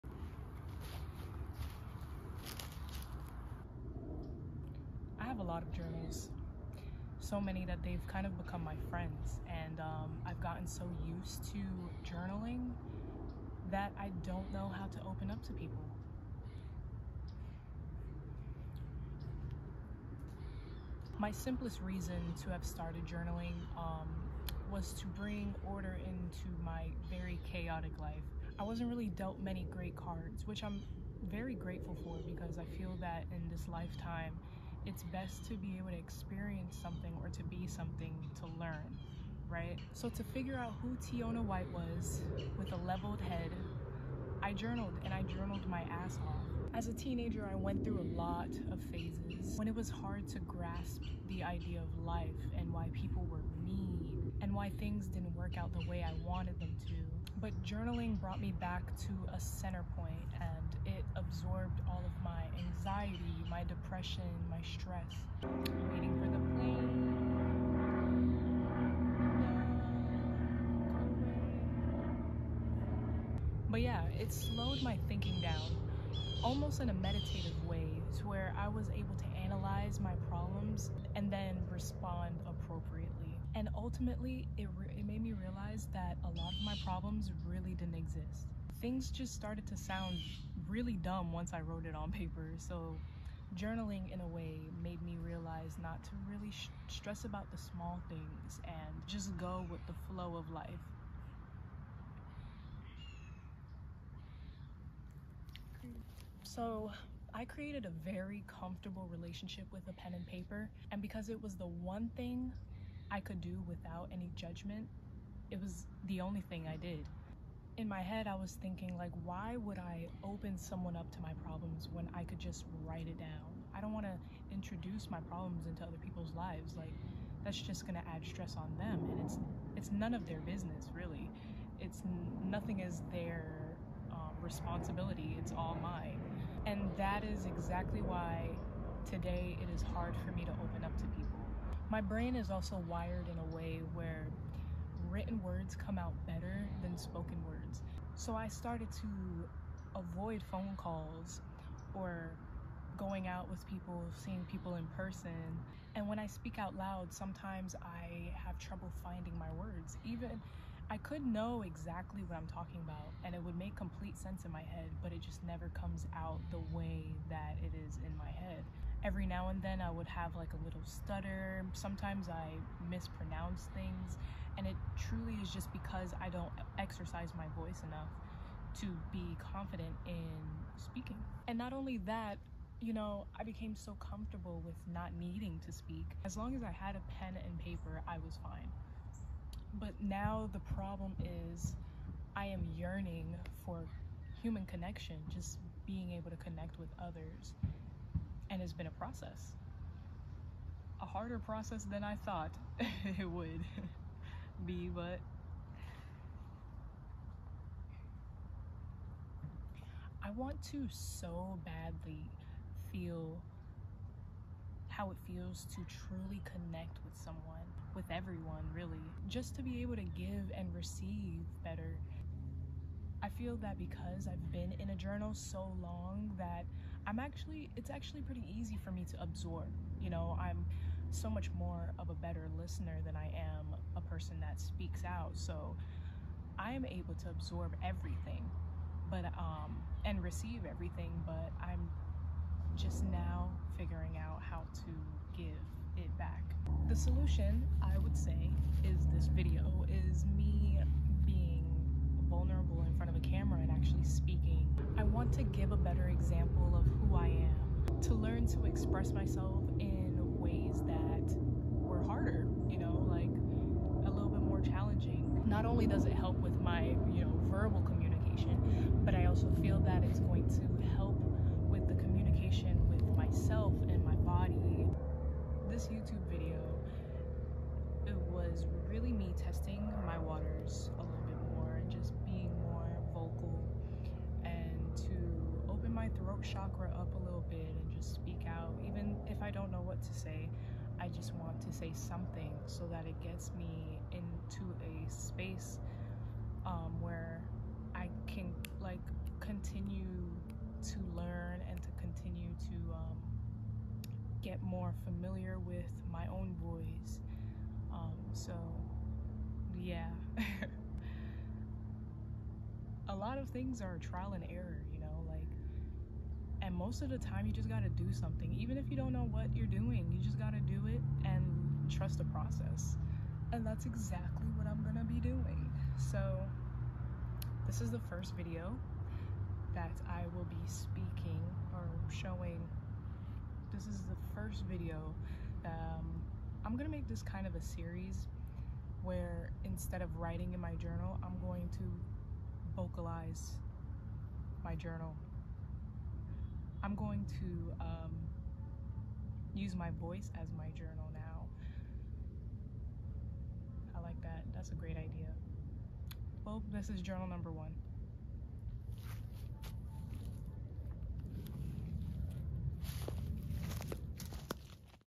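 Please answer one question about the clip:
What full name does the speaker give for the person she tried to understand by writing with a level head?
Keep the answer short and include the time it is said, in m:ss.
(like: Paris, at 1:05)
Tiona White, at 0:40.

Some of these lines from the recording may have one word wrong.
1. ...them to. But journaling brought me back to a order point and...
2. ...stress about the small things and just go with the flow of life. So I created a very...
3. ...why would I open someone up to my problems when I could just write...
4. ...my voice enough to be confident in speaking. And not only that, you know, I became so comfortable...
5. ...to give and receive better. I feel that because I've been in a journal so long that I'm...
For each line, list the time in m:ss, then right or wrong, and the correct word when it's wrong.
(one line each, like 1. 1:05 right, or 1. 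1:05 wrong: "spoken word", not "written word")
1. 0:56 wrong: "center", not "order"
2. 1:36 right
3. 1:59 right
4. 2:57 right
5. 3:39 right.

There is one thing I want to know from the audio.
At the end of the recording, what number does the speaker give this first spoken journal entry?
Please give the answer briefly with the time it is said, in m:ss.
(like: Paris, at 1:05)
1, at 5:57.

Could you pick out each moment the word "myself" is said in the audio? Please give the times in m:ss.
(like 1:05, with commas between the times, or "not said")
4:19, 4:33.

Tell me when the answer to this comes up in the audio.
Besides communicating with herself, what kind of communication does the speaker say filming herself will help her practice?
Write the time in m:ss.
4:27.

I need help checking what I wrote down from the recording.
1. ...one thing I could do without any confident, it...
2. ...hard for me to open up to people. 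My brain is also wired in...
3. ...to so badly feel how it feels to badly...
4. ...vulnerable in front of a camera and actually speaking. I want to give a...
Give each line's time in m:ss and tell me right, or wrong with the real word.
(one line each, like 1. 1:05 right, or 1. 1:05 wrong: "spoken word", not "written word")
1. 1:51 wrong: "judgment", not "confident"
2. 2:19 right
3. 3:30 wrong: "truly", not "badly"
4. 4:12 right.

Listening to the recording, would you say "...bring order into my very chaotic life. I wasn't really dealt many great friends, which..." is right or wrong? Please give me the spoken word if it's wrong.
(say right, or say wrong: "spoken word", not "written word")
wrong: "cards", not "friends".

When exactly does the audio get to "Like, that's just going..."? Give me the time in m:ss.
2:06.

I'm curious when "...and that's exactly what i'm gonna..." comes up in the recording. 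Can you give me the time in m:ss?
5:23.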